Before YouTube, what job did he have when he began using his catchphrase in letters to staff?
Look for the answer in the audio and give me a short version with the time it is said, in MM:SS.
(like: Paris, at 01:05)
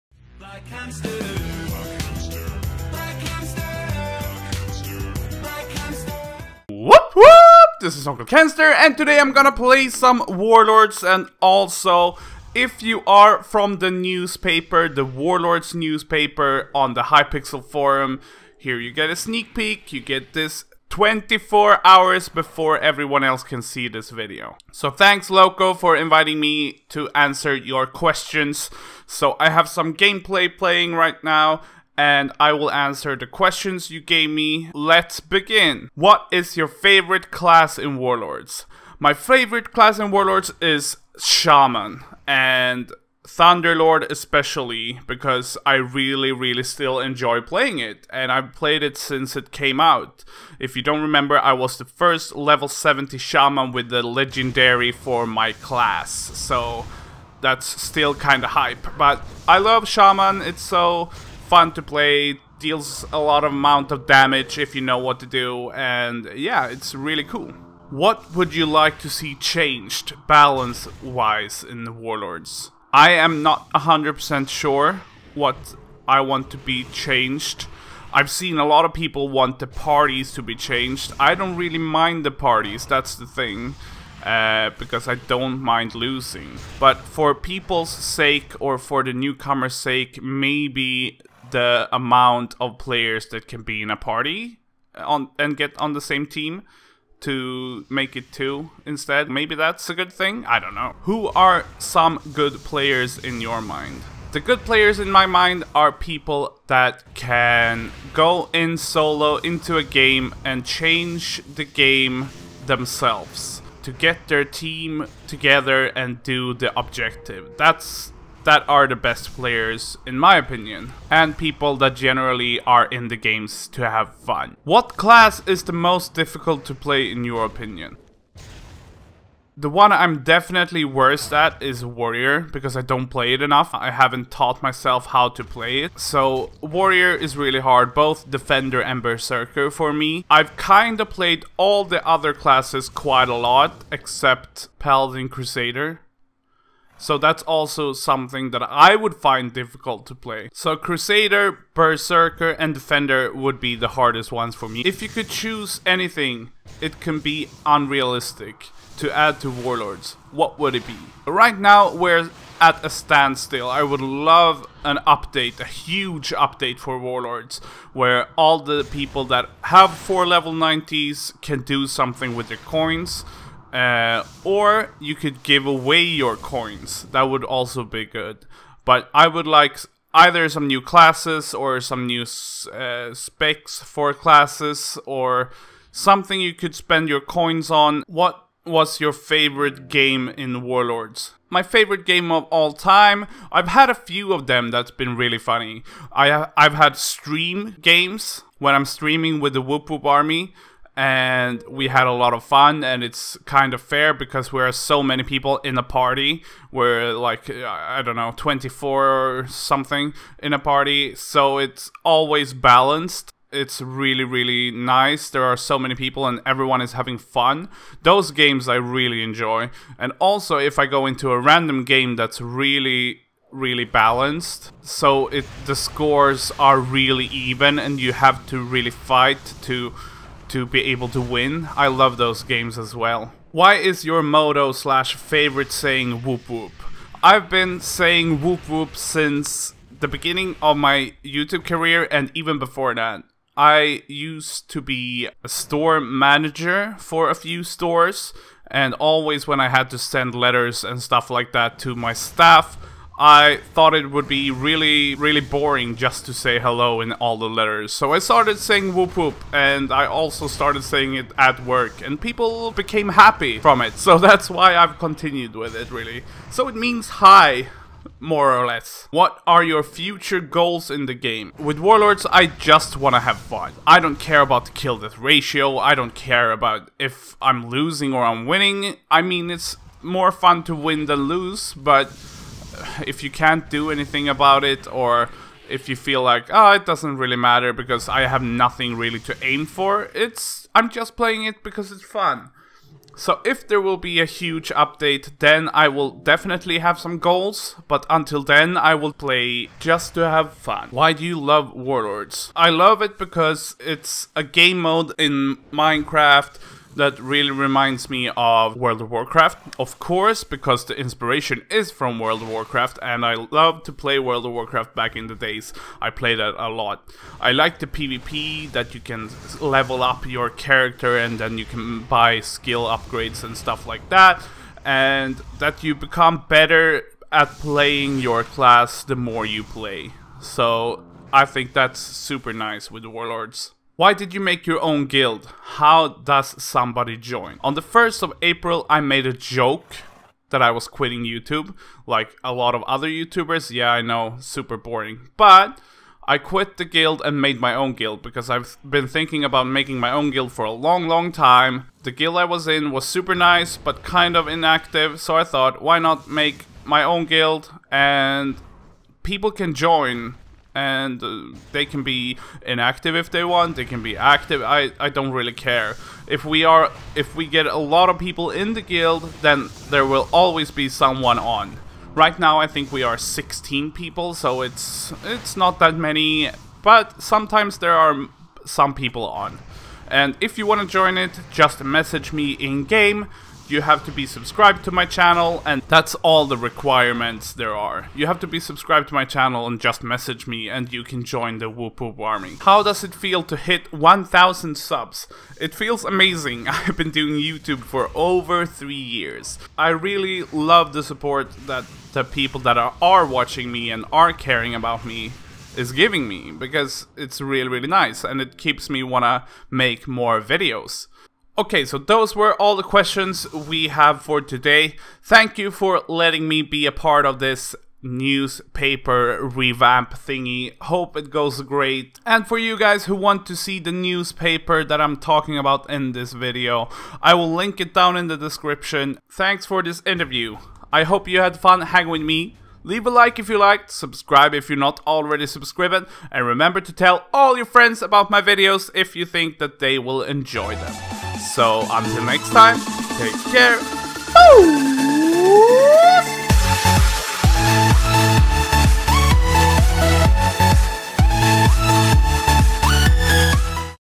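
Store manager, at 04:05.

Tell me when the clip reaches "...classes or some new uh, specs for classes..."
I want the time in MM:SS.
03:00.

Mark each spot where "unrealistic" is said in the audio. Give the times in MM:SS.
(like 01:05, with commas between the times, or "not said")
02:37.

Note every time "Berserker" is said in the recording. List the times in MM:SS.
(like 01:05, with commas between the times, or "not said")
02:19, 02:31.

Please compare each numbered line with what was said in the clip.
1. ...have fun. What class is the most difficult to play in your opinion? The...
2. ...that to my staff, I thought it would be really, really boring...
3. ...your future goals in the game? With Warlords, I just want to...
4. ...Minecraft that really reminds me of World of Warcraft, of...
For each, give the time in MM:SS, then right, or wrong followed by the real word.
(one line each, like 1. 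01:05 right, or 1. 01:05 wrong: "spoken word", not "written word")
1. 02:03 right
2. 04:11 right
3. 04:29 right
4. 05:05 right.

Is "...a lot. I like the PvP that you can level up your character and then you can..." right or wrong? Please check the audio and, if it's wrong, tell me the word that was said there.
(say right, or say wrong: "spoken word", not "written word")
right.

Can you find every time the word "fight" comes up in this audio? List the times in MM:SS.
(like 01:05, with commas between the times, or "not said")
03:48.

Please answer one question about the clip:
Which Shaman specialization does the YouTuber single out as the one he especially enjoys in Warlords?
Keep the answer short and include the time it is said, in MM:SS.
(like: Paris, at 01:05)
Thunderlord, at 00:43.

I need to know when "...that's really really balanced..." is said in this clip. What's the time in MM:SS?
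03:42.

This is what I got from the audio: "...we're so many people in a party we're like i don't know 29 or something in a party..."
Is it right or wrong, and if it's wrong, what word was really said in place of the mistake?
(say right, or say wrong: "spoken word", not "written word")
wrong: "24", not "29".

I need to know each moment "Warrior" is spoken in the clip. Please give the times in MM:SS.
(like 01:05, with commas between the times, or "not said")
02:11, 02:16.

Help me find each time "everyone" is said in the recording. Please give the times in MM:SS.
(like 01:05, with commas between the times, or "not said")
00:22, 03:36.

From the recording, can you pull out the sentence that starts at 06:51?
Okay, so those were all the questions we have for today.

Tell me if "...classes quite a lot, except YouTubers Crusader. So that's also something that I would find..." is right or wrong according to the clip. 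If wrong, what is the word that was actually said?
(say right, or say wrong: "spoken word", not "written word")
wrong: "Paladin", not "YouTubers".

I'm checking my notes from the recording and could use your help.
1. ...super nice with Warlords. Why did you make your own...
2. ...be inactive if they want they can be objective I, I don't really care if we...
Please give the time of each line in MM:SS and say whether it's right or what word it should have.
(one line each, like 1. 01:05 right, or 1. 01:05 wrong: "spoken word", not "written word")
1. 05:31 right
2. 06:02 wrong: "active", not "objective".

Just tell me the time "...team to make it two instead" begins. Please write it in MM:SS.
01:36.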